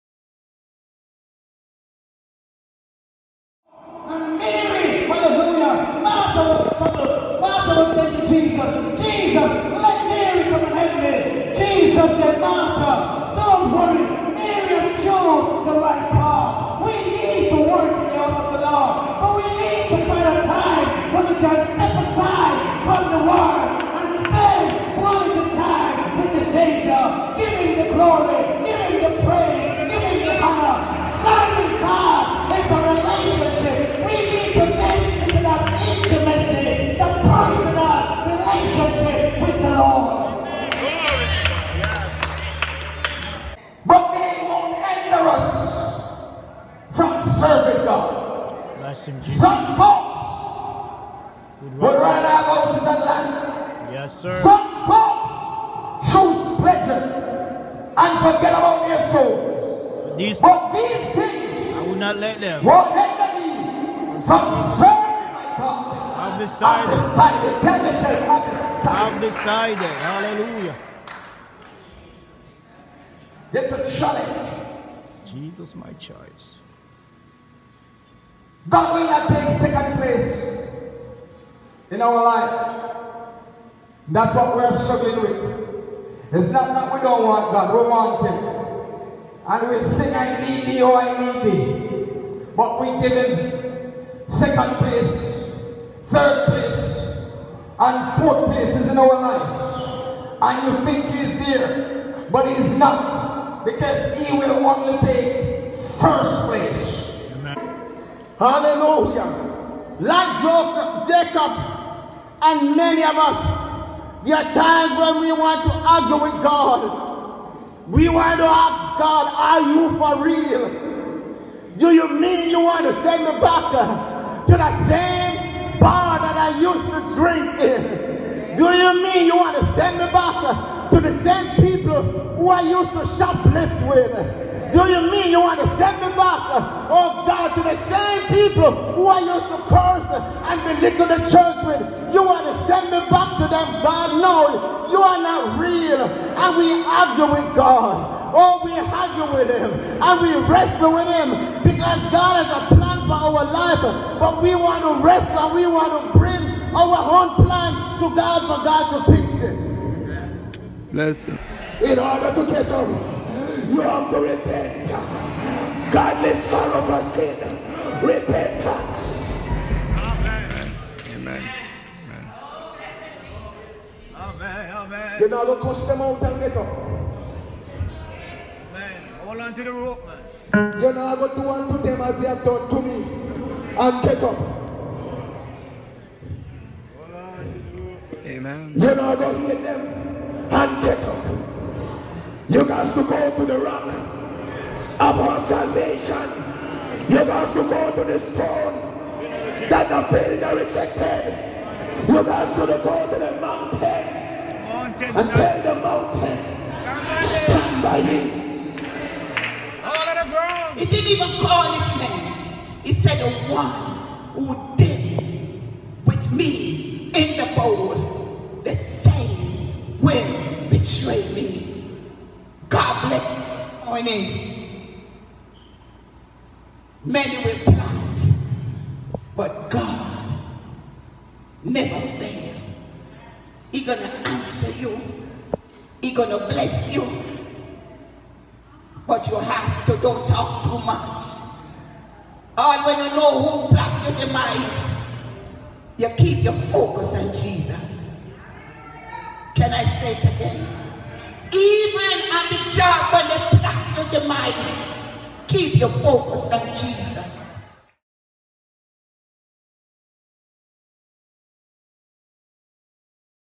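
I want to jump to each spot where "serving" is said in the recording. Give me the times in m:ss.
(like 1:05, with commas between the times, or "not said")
1:04.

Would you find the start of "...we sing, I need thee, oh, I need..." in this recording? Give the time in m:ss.
1:29.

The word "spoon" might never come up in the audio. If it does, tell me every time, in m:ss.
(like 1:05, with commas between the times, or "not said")
not said.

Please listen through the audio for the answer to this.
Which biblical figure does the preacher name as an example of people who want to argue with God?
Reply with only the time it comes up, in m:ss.
1:51.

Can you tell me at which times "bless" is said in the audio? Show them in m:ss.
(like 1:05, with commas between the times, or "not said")
2:40, 3:56.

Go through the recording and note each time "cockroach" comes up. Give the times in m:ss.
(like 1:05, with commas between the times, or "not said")
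not said.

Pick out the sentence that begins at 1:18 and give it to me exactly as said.
God will not take second place in our life.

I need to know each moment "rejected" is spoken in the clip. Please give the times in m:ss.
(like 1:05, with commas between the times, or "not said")
3:20.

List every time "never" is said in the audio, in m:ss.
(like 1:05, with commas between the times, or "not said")
3:51.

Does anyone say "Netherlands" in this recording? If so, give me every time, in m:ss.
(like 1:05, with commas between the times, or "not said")
not said.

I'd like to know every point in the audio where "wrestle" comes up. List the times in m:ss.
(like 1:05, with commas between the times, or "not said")
2:30, 2:35.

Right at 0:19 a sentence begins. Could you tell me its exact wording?
But we need to find a time when we can step aside from the world and spend quality time with the Savior.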